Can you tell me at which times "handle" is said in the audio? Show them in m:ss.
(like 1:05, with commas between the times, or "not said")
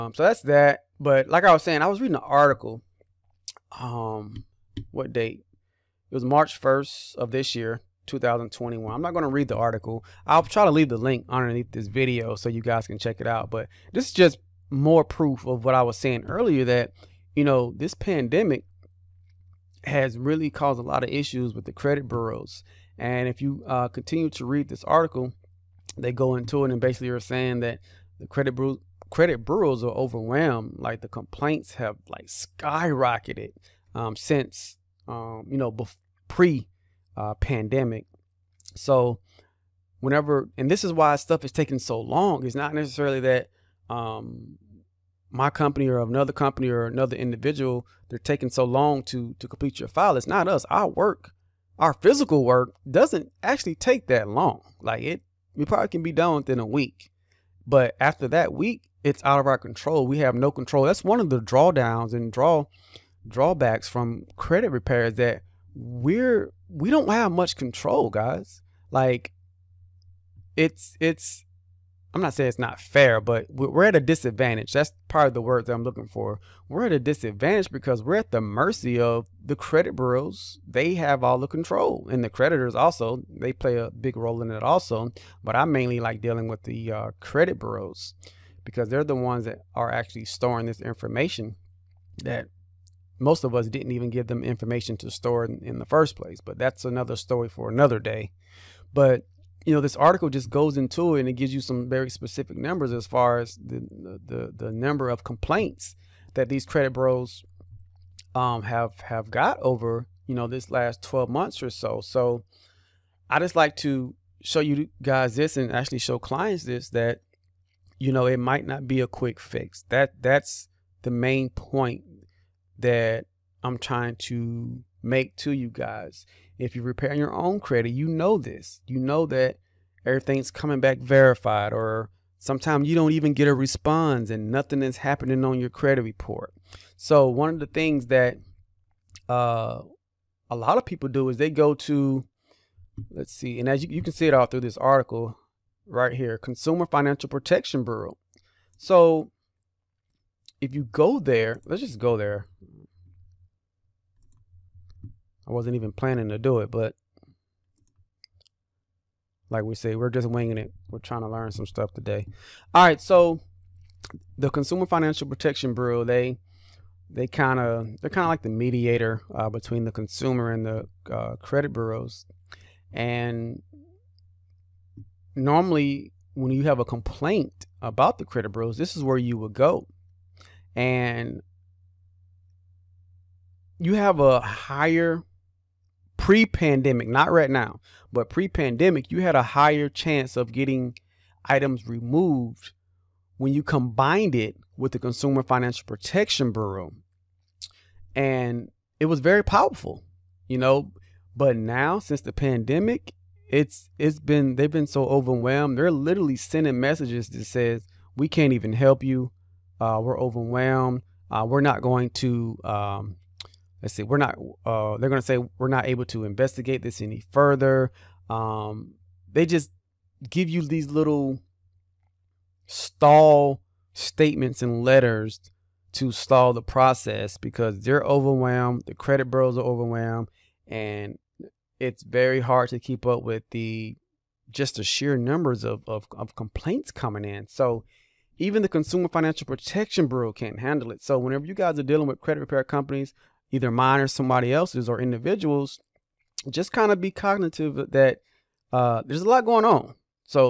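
4:00.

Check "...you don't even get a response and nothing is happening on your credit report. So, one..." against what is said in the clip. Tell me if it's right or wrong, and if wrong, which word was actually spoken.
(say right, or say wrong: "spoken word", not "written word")
right.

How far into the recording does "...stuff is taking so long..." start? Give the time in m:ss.
0:41.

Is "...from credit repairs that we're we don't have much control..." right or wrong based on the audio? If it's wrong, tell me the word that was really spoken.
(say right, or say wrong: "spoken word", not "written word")
right.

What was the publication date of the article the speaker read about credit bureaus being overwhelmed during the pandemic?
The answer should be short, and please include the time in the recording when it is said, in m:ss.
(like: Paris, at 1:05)
March 1st, 2021, at 0:06.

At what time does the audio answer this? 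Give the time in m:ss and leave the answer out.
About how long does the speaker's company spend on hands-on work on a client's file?
0:56.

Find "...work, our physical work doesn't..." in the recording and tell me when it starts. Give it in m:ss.
0:50.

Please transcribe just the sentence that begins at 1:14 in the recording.
That's part of the word that I'm looking for.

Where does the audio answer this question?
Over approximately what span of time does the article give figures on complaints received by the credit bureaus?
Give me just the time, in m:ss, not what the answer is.
1:50.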